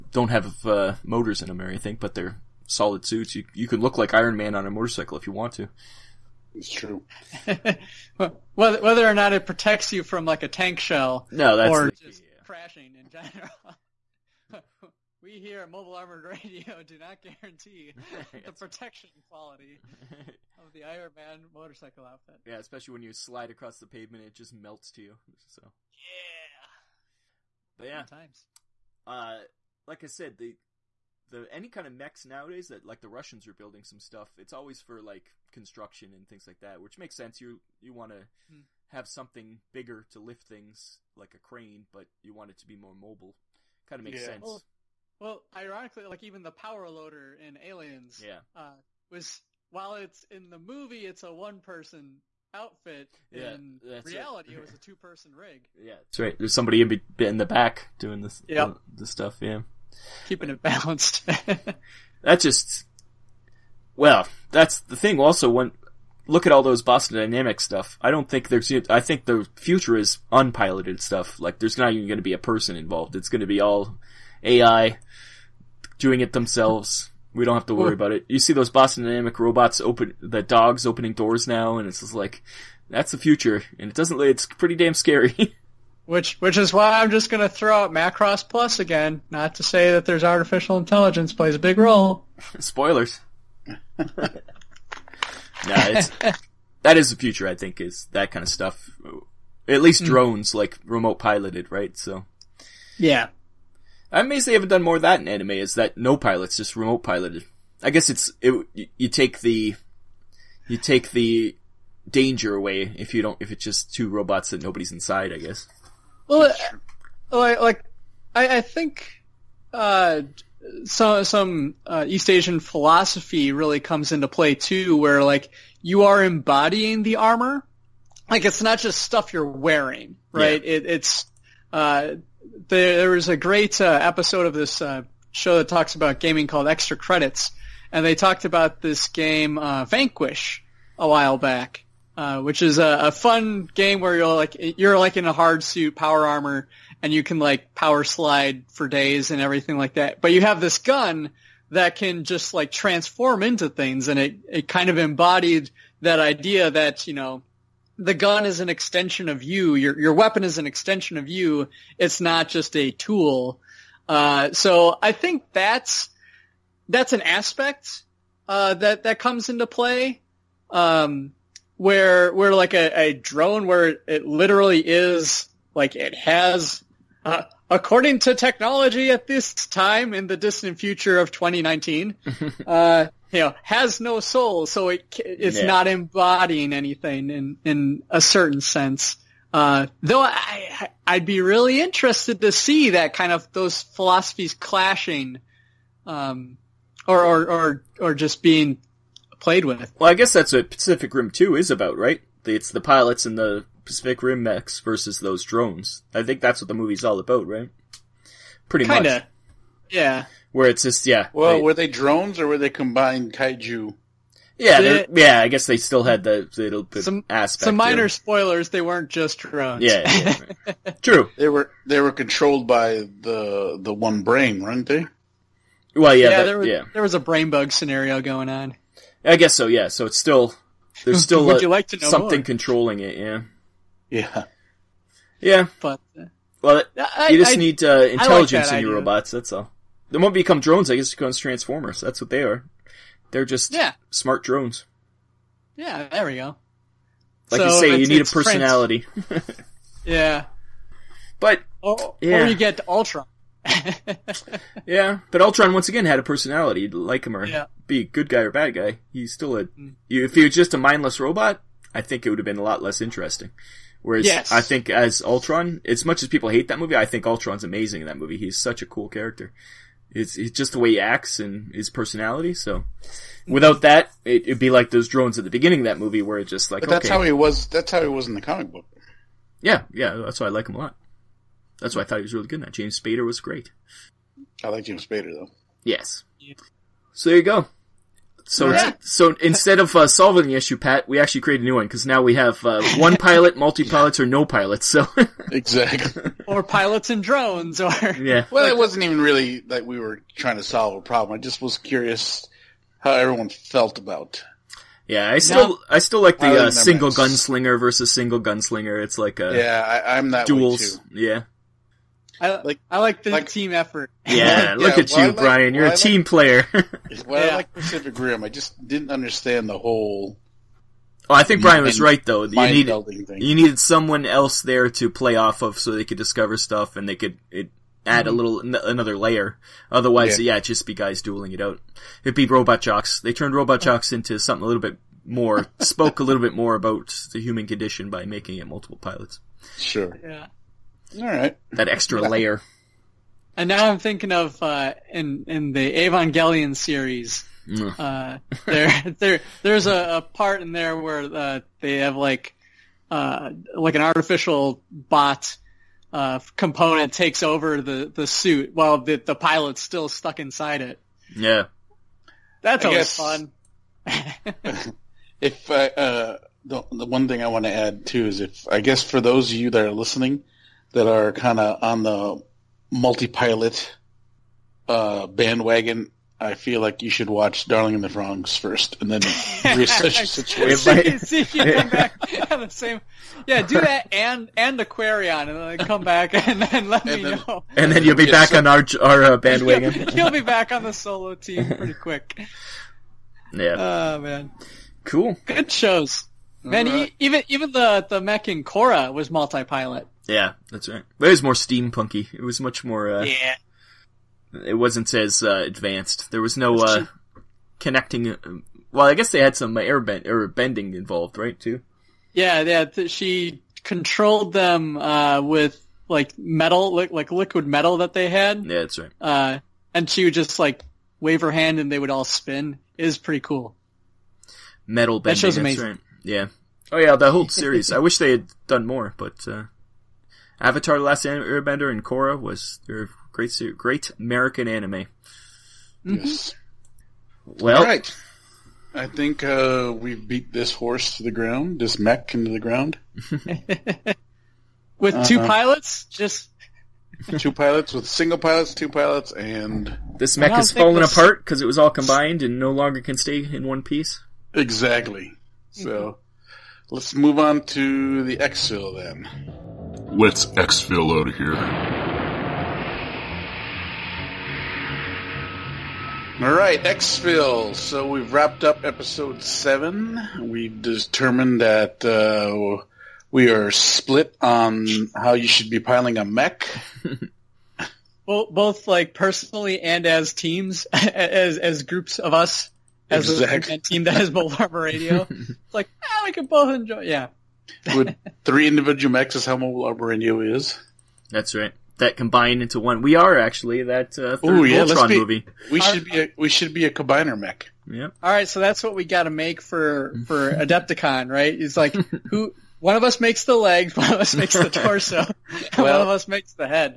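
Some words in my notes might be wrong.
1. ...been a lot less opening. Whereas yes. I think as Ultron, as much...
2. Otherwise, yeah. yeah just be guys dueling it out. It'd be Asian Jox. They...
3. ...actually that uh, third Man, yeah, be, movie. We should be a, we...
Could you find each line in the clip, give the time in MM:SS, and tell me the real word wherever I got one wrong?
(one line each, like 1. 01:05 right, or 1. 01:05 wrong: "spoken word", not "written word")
1. 04:22 wrong: "interesting", not "opening"
2. 05:29 wrong: "Robot", not "Asian"
3. 08:13 wrong: "Ooh", not "Man".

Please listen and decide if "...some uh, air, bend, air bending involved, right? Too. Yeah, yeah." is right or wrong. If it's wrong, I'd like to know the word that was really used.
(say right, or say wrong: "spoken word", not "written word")
right.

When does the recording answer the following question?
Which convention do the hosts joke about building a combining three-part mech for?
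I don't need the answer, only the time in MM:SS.
08:20.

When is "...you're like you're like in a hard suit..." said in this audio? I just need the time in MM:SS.
02:24.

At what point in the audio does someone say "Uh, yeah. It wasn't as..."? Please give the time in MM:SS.
06:43.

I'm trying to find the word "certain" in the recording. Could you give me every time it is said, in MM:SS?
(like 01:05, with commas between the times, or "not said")
03:08.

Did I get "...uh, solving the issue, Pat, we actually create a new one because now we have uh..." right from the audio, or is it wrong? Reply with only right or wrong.
right.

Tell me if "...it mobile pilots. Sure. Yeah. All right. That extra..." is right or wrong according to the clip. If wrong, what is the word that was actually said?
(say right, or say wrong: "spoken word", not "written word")
wrong: "multiple", not "mobile".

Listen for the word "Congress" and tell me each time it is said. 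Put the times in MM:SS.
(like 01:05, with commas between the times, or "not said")
not said.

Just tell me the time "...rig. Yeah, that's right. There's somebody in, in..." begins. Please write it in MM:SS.
00:55.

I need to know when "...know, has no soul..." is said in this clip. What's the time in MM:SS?
03:03.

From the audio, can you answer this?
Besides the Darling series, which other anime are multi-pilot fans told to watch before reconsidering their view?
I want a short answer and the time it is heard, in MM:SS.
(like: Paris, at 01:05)
Aquarion, at 06:24.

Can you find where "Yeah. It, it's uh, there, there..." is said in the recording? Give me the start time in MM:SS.
02:10.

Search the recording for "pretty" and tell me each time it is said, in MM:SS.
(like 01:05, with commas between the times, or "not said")
01:24, 03:28, 06:31, 07:03.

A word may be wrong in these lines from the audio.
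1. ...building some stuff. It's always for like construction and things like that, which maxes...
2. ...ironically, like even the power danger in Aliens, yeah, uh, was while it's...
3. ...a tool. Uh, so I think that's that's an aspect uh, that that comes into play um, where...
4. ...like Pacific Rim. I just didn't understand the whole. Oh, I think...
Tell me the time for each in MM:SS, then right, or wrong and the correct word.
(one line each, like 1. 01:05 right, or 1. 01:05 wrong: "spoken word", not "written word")
1. 00:33 wrong: "makes", not "maxes"
2. 00:45 wrong: "loader", not "danger"
3. 02:42 right
4. 05:17 right.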